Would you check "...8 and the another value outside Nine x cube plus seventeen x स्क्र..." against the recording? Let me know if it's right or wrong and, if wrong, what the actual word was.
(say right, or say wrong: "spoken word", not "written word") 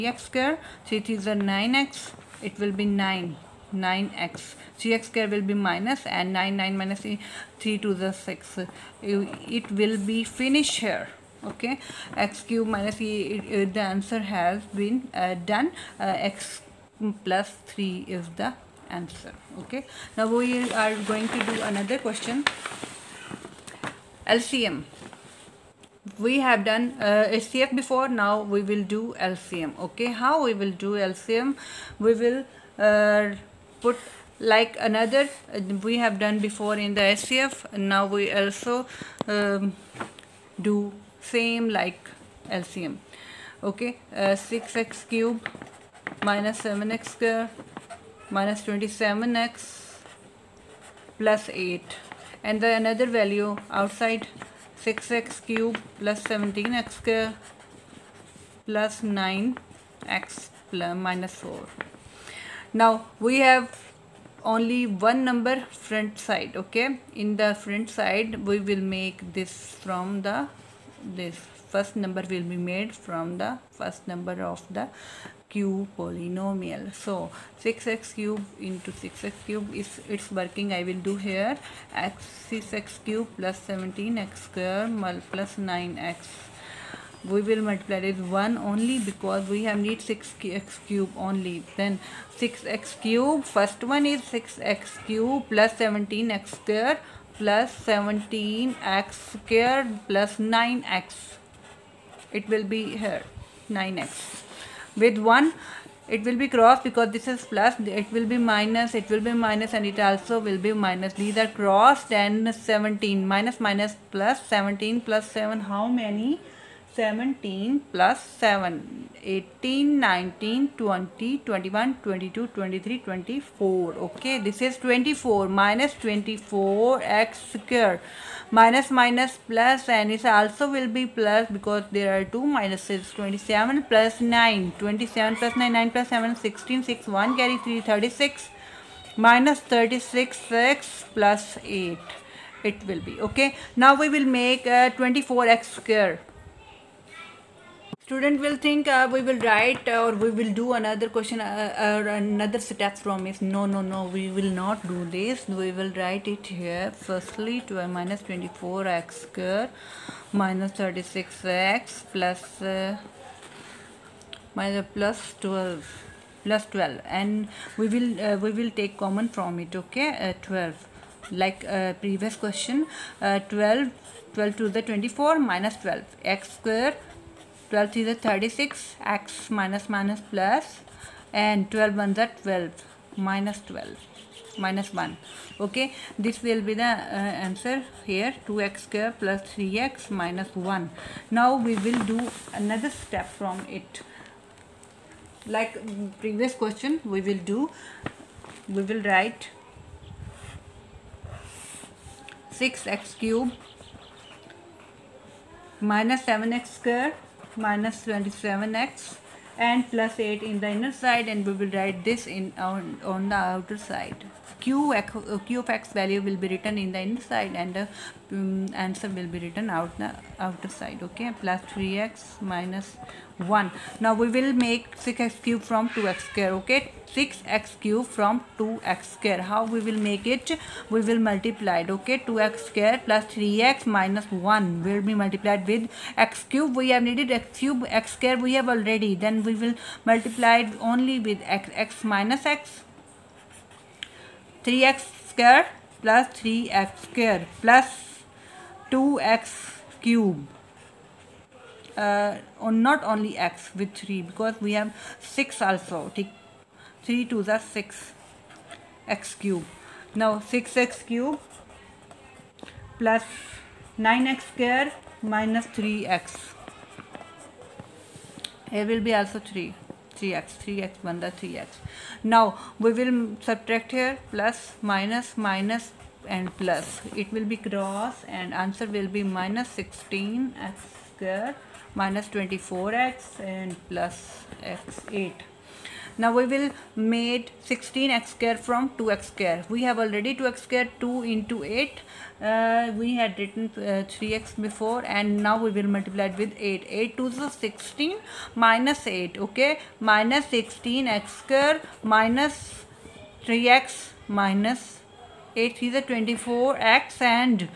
wrong: "Six", not "Nine".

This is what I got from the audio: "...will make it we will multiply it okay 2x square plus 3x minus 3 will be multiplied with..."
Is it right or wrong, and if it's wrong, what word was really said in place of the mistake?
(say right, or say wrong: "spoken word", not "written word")
wrong: "1", not "3".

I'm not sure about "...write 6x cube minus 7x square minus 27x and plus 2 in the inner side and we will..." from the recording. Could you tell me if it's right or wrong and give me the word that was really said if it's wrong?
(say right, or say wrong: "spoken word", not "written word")
wrong: "8", not "2".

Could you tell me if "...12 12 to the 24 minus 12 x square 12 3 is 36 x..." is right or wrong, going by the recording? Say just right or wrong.
right.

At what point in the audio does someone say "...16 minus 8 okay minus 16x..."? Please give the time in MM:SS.
04:57.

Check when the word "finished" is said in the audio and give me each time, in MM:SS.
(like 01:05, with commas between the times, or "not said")
00:10.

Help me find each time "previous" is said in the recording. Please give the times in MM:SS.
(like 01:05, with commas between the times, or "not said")
02:52, 03:16.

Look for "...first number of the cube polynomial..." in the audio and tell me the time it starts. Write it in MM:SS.
01:13.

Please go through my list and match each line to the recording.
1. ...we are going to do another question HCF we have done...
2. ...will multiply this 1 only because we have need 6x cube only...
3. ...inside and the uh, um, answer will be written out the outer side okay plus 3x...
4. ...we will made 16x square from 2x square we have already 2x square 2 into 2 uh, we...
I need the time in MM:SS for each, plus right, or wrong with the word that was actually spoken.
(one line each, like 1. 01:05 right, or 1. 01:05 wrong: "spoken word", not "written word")
1. 00:20 wrong: "LCM", not "HCF"
2. 01:27 right
3. 03:37 right
4. 04:46 wrong: "8", not "2".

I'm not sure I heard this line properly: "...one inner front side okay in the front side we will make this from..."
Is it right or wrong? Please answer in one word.
wrong.